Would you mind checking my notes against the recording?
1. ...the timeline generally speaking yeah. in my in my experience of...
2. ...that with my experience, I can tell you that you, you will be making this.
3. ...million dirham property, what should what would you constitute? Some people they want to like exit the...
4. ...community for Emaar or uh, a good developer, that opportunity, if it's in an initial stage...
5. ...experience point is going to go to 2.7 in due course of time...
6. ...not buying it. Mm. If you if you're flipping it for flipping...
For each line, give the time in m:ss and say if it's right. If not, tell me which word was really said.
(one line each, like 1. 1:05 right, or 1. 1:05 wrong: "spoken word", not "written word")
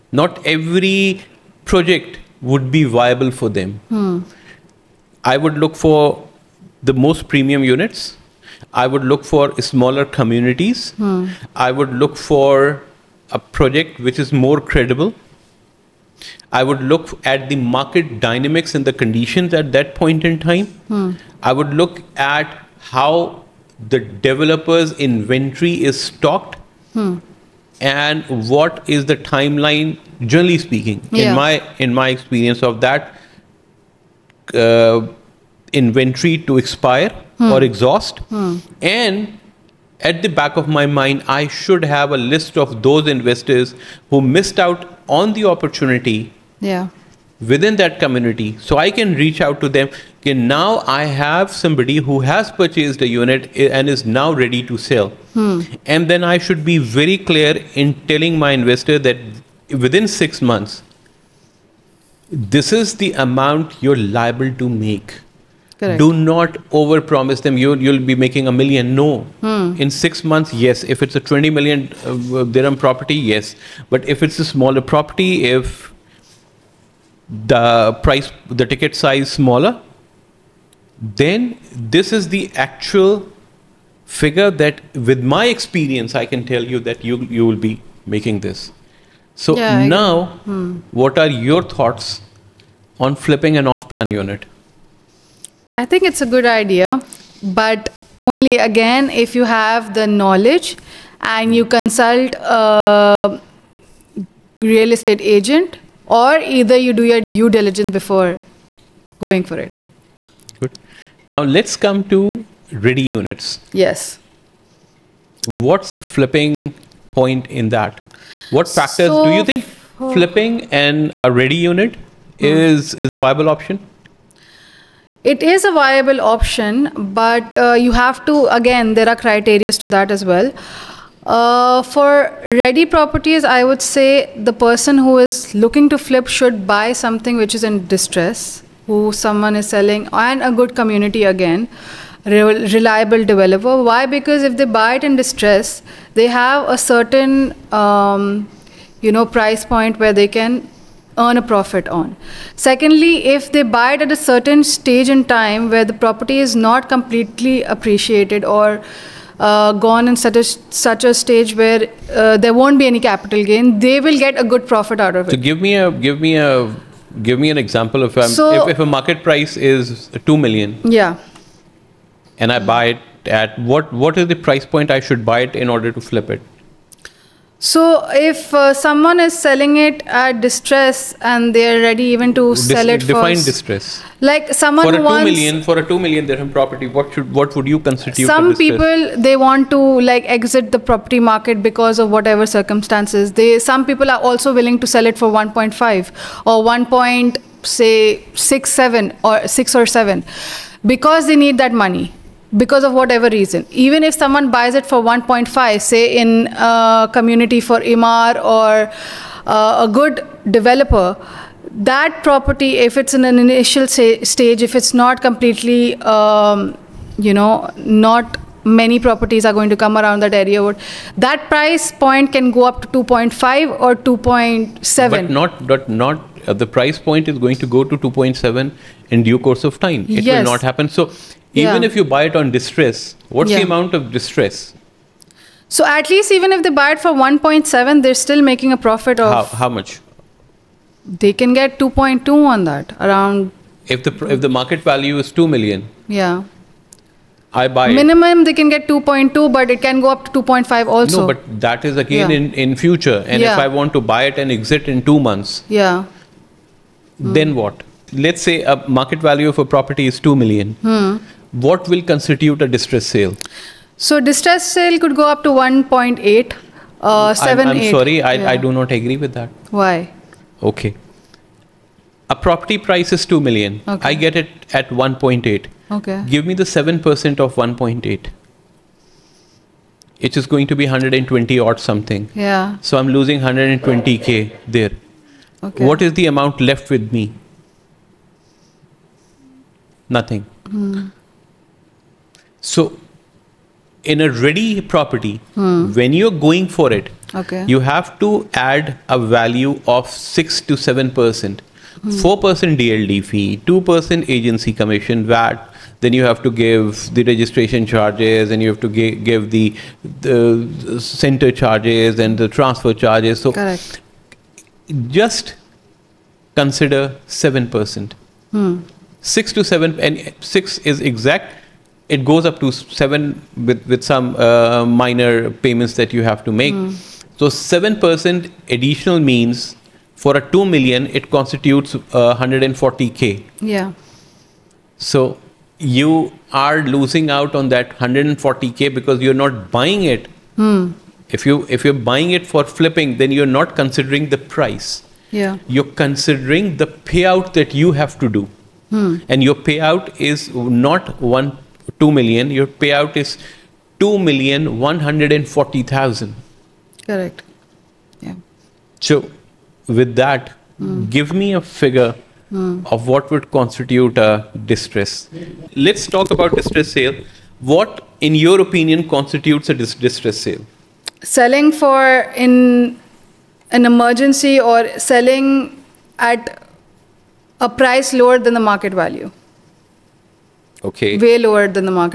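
1. 0:29 right
2. 1:24 right
3. 3:06 right
4. 3:27 wrong: "property", not "opportunity"
5. 3:46 wrong: "price", not "experience"
6. 5:39 wrong: "buying", not "flipping".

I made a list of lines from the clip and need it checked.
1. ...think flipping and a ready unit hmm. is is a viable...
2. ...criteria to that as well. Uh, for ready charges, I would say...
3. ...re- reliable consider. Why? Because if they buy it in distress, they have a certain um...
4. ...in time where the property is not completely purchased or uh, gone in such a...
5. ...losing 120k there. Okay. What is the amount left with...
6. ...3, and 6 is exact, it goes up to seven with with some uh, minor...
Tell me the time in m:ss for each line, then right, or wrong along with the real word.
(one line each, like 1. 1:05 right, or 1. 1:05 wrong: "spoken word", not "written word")
1. 1:59 right
2. 2:09 wrong: "properties", not "charges"
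3. 2:22 wrong: "developer", not "consider"
4. 2:35 wrong: "appreciated", not "purchased"
5. 4:43 right
6. 5:19 wrong: "7", not "3".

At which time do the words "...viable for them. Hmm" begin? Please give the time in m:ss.
0:02.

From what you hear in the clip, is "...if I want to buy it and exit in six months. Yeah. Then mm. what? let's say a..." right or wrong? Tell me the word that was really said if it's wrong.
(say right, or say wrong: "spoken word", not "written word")
wrong: "two", not "six".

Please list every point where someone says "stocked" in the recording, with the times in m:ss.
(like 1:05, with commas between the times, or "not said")
0:26.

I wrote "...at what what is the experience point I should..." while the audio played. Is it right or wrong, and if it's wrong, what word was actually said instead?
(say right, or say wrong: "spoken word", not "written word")
wrong: "price", not "experience".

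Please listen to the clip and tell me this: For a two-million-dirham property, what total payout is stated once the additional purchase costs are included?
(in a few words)
2,140,000.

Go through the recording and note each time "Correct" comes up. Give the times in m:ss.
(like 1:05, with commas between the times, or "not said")
1:05, 5:13, 5:57.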